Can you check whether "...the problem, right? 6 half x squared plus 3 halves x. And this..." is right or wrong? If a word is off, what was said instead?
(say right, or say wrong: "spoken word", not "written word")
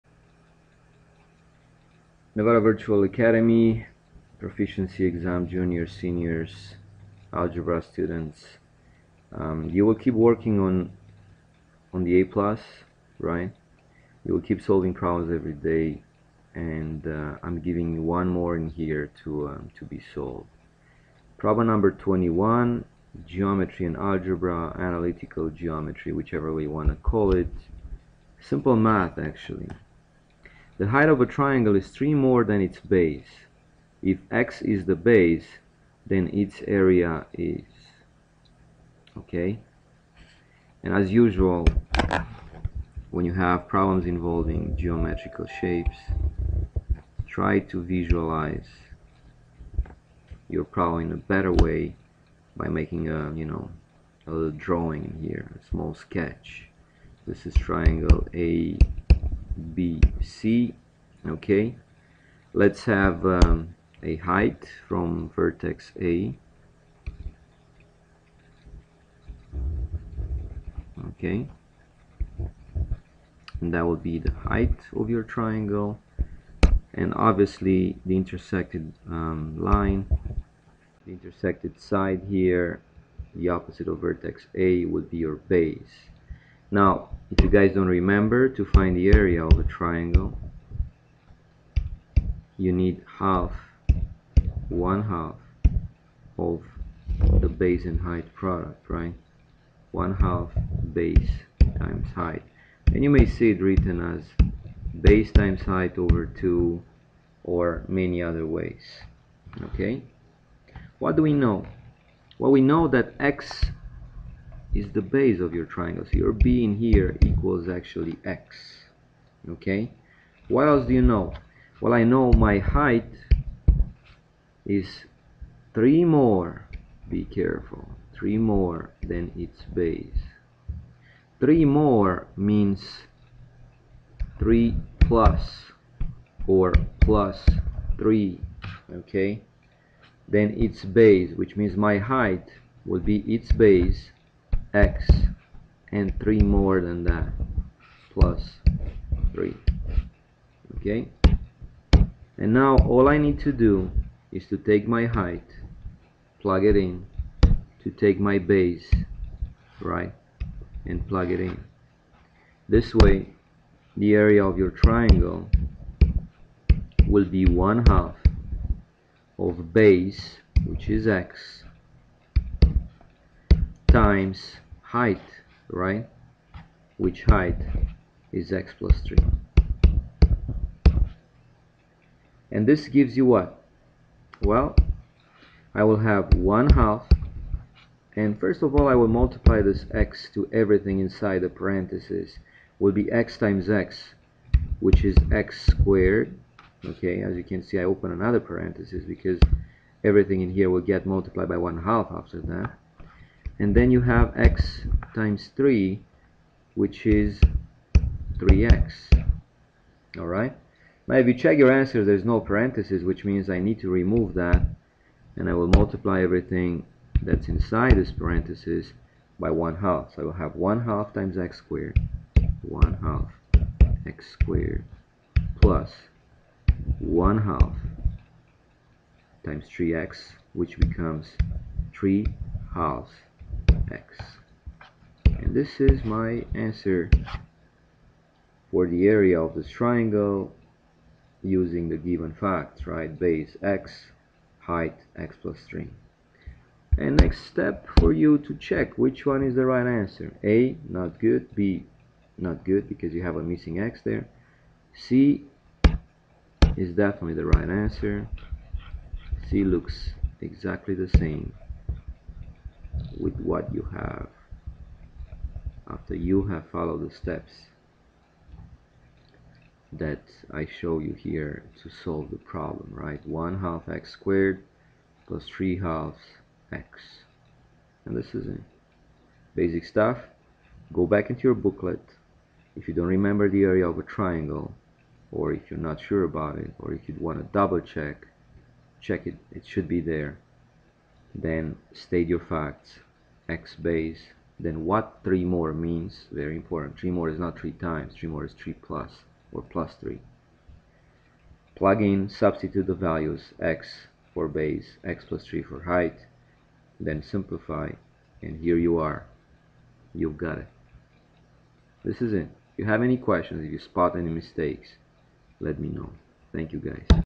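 wrong: "1", not "6".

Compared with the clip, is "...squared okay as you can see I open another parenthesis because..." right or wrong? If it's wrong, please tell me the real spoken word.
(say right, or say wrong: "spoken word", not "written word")
right.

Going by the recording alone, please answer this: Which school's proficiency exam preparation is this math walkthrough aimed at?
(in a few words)
Nevada Virtual Academy.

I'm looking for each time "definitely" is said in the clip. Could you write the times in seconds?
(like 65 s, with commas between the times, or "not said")
256 s.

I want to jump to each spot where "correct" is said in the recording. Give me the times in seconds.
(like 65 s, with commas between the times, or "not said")
not said.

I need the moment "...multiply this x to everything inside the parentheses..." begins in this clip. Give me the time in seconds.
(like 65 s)
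189 s.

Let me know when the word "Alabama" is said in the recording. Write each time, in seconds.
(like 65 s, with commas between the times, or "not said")
not said.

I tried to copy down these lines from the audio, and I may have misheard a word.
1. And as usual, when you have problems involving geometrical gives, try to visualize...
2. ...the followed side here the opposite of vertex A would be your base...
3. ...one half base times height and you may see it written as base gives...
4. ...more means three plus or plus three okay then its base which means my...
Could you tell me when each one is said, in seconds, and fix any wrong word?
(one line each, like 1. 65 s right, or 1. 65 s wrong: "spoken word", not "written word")
1. 40 s wrong: "shapes", not "gives"
2. 81 s wrong: "intersected", not "followed"
3. 99 s wrong: "times", not "gives"
4. 131 s right.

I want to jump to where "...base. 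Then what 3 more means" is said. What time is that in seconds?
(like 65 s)
293 s.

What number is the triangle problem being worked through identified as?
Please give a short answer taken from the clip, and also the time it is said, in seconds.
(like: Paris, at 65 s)
21, at 21 s.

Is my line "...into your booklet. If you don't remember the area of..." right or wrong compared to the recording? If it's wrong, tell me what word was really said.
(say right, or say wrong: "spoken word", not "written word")
right.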